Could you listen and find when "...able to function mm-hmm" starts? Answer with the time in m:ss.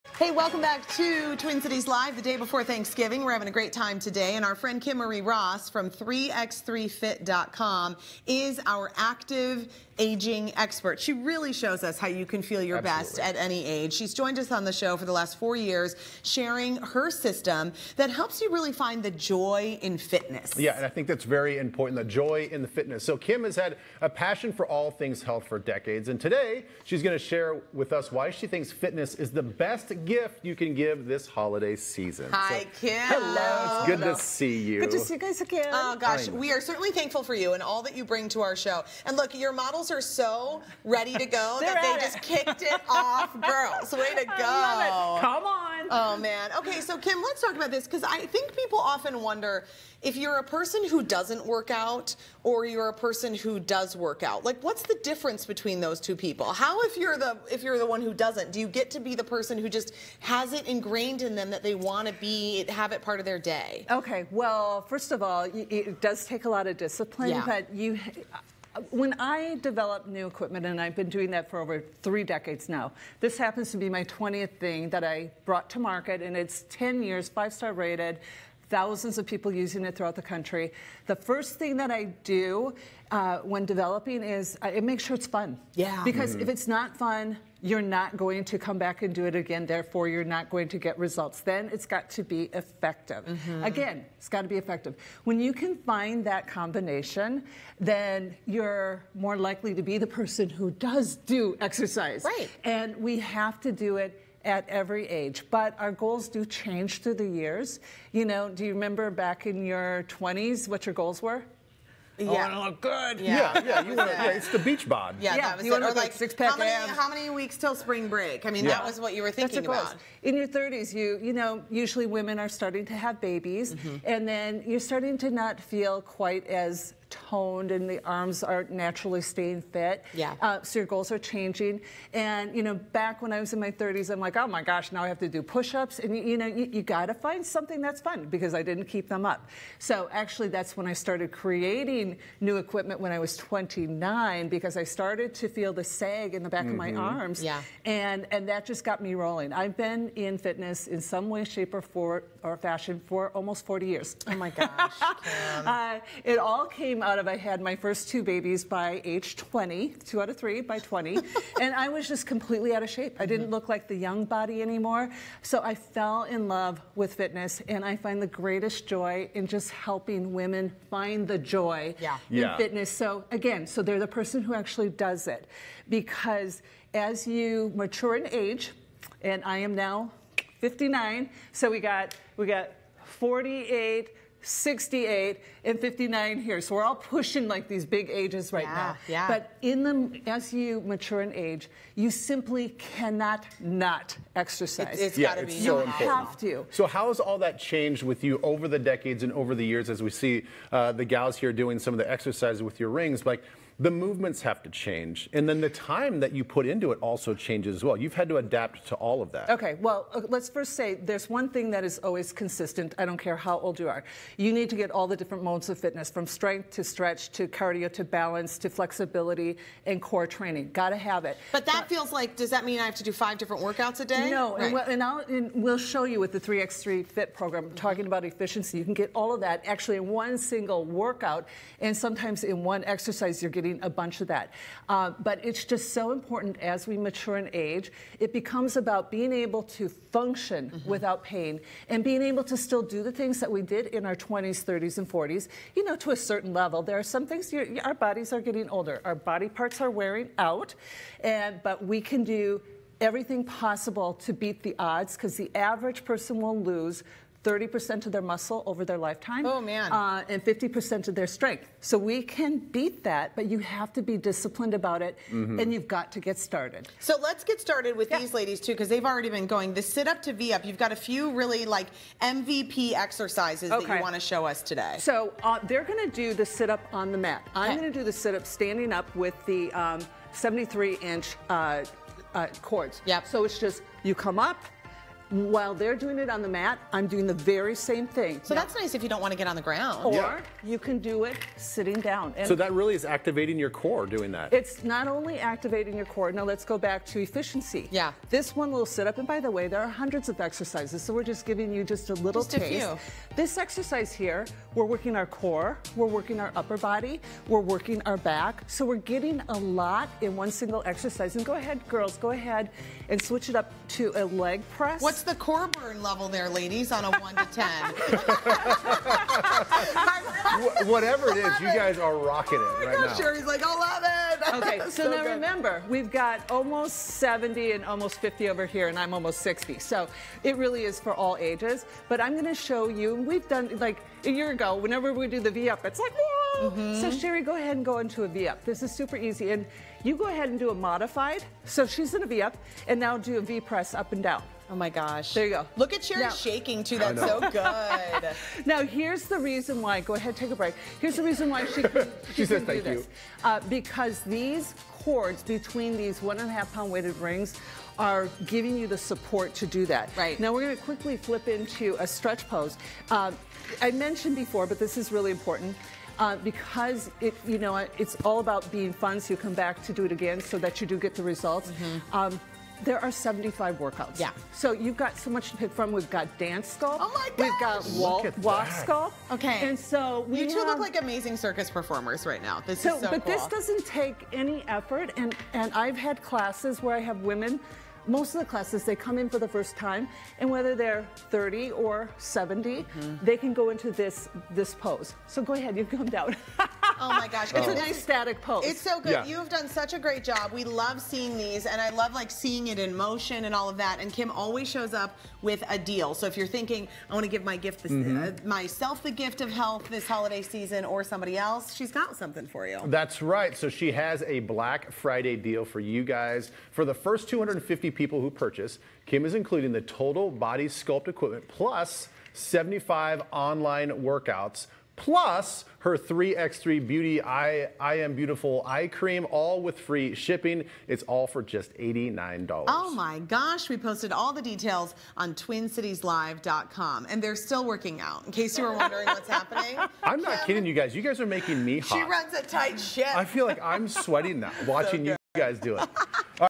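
3:59.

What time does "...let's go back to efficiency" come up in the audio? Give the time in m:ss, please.
4:56.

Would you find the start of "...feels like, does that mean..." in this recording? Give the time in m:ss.
3:41.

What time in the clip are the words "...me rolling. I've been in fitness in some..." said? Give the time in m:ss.
2:28.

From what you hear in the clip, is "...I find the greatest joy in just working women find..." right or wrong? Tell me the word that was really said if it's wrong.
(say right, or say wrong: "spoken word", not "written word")
wrong: "helping", not "working".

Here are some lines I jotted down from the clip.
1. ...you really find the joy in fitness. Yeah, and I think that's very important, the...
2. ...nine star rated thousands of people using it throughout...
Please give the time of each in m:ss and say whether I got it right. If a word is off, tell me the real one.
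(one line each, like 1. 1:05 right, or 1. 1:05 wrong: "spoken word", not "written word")
1. 0:18 right
2. 1:17 wrong: "five", not "nine".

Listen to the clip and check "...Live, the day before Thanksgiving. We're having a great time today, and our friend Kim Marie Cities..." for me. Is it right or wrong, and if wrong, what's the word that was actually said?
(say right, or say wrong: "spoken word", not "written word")
wrong: "Ross", not "Cities".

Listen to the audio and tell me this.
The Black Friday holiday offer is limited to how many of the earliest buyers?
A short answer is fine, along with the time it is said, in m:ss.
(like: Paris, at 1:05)
250, at 6:57.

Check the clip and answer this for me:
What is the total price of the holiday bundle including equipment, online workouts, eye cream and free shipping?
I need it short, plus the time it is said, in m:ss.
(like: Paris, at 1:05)
$89, at 7:11.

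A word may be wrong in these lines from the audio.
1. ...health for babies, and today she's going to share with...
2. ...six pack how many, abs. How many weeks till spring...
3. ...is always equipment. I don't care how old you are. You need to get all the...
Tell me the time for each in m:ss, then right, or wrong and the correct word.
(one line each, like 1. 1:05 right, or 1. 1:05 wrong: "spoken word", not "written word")
1. 0:25 wrong: "decades", not "babies"
2. 1:56 right
3. 3:31 wrong: "consistent", not "equipment".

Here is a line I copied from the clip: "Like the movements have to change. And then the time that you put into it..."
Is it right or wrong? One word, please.
right.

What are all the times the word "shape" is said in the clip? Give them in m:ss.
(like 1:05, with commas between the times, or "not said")
2:31, 2:42.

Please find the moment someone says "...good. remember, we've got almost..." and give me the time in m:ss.
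5:25.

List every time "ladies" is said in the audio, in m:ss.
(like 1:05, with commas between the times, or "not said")
4:28, 5:16.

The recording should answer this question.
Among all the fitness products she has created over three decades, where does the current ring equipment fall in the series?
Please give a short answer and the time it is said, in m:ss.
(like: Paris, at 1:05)
20th, at 1:14.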